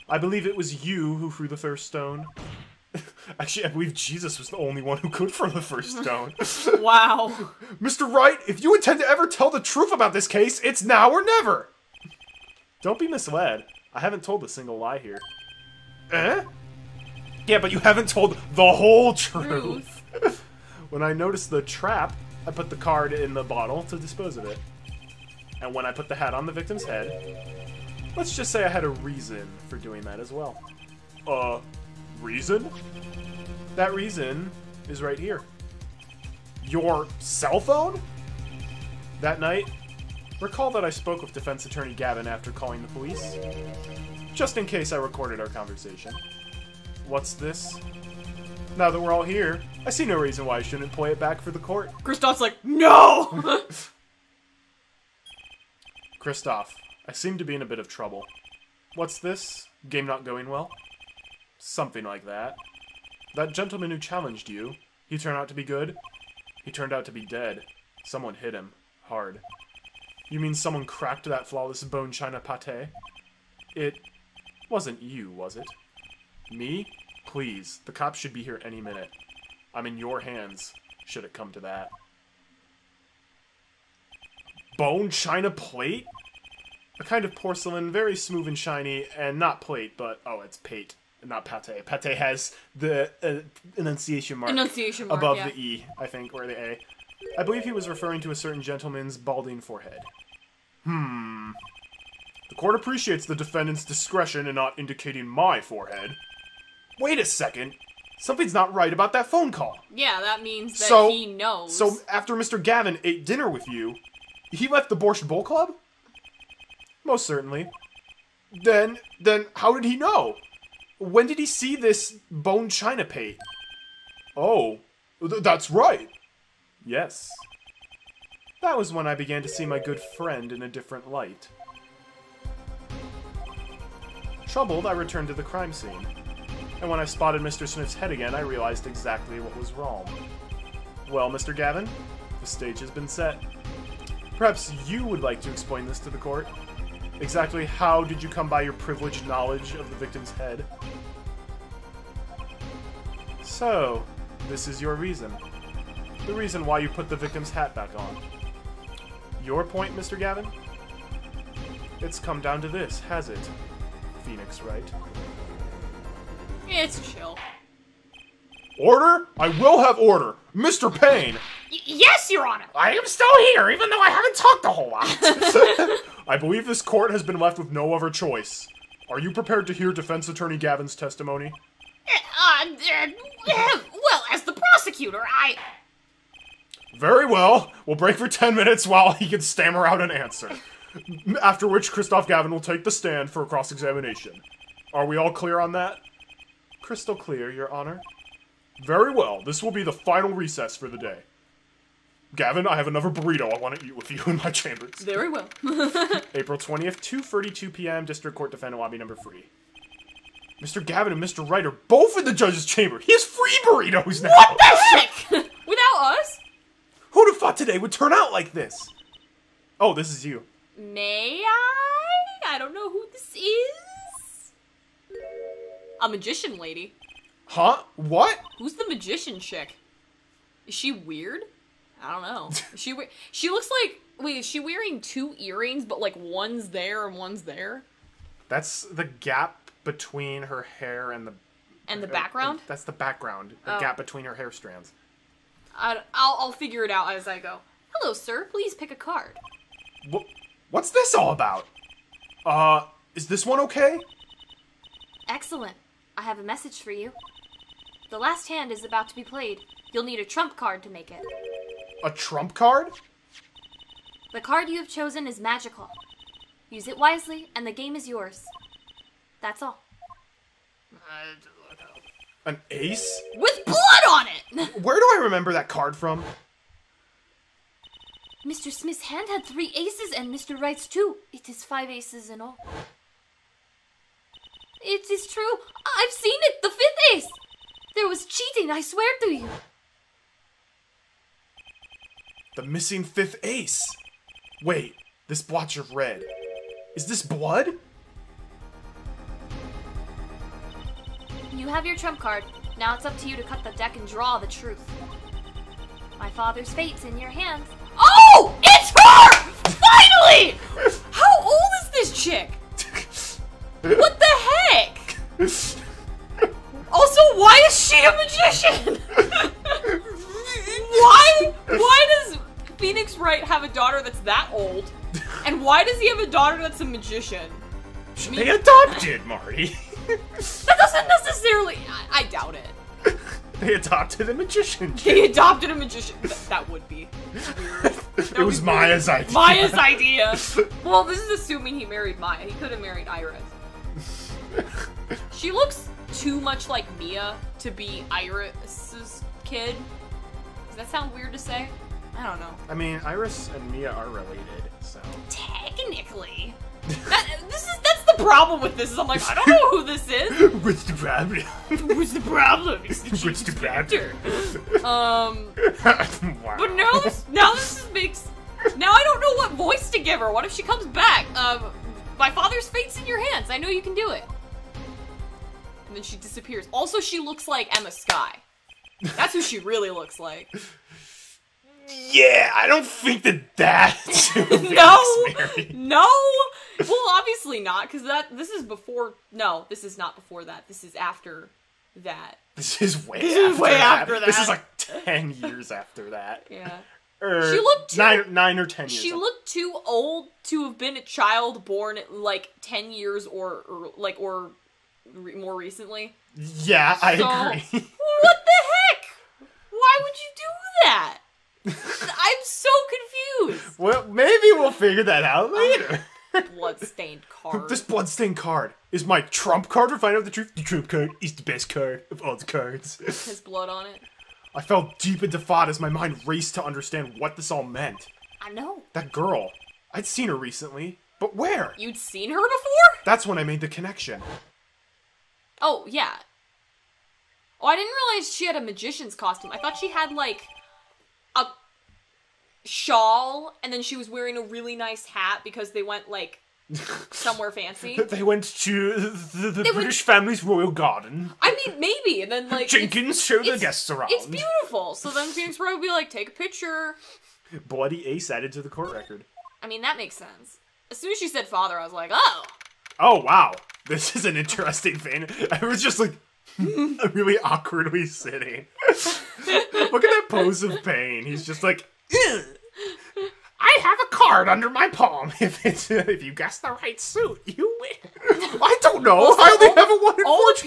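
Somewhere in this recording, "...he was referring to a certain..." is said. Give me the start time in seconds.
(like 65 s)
97 s.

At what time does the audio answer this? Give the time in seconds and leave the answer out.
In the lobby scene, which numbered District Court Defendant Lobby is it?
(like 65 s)
209 s.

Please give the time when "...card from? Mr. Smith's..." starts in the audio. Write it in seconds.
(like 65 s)
275 s.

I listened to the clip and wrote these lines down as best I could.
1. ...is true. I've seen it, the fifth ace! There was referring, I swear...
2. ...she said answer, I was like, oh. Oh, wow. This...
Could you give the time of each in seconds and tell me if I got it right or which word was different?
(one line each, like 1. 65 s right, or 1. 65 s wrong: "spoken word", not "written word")
1. 285 s wrong: "cheating", not "referring"
2. 461 s wrong: "father", not "answer".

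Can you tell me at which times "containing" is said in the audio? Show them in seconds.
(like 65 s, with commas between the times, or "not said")
not said.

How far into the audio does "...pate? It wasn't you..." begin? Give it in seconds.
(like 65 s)
72 s.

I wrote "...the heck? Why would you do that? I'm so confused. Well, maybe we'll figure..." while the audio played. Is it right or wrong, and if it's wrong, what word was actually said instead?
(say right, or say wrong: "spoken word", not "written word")
right.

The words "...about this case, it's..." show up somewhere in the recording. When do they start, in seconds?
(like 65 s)
9 s.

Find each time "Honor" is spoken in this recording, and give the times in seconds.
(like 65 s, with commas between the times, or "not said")
172 s, 197 s.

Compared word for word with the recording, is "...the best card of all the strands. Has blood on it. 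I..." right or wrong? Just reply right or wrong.
wrong.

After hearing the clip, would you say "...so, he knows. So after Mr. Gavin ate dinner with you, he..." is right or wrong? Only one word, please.
right.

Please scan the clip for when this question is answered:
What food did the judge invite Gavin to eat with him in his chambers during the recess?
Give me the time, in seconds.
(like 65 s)
203 s.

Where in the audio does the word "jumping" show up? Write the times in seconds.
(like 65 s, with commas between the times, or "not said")
not said.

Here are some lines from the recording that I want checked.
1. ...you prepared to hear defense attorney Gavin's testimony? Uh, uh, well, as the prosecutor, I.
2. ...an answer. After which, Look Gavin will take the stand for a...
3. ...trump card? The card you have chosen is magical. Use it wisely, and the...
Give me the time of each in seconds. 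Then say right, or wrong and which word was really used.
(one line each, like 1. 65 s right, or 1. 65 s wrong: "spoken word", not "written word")
1. 179 s right
2. 190 s wrong: "Kristoph", not "Look"
3. 262 s right.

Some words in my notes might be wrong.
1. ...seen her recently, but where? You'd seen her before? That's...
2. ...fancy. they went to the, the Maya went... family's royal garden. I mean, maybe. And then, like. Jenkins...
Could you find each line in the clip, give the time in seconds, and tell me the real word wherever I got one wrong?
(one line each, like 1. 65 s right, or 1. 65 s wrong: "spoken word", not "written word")
1. 430 s right
2. 447 s wrong: "British", not "Maya".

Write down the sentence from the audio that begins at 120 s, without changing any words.
When did he see this bone china plate?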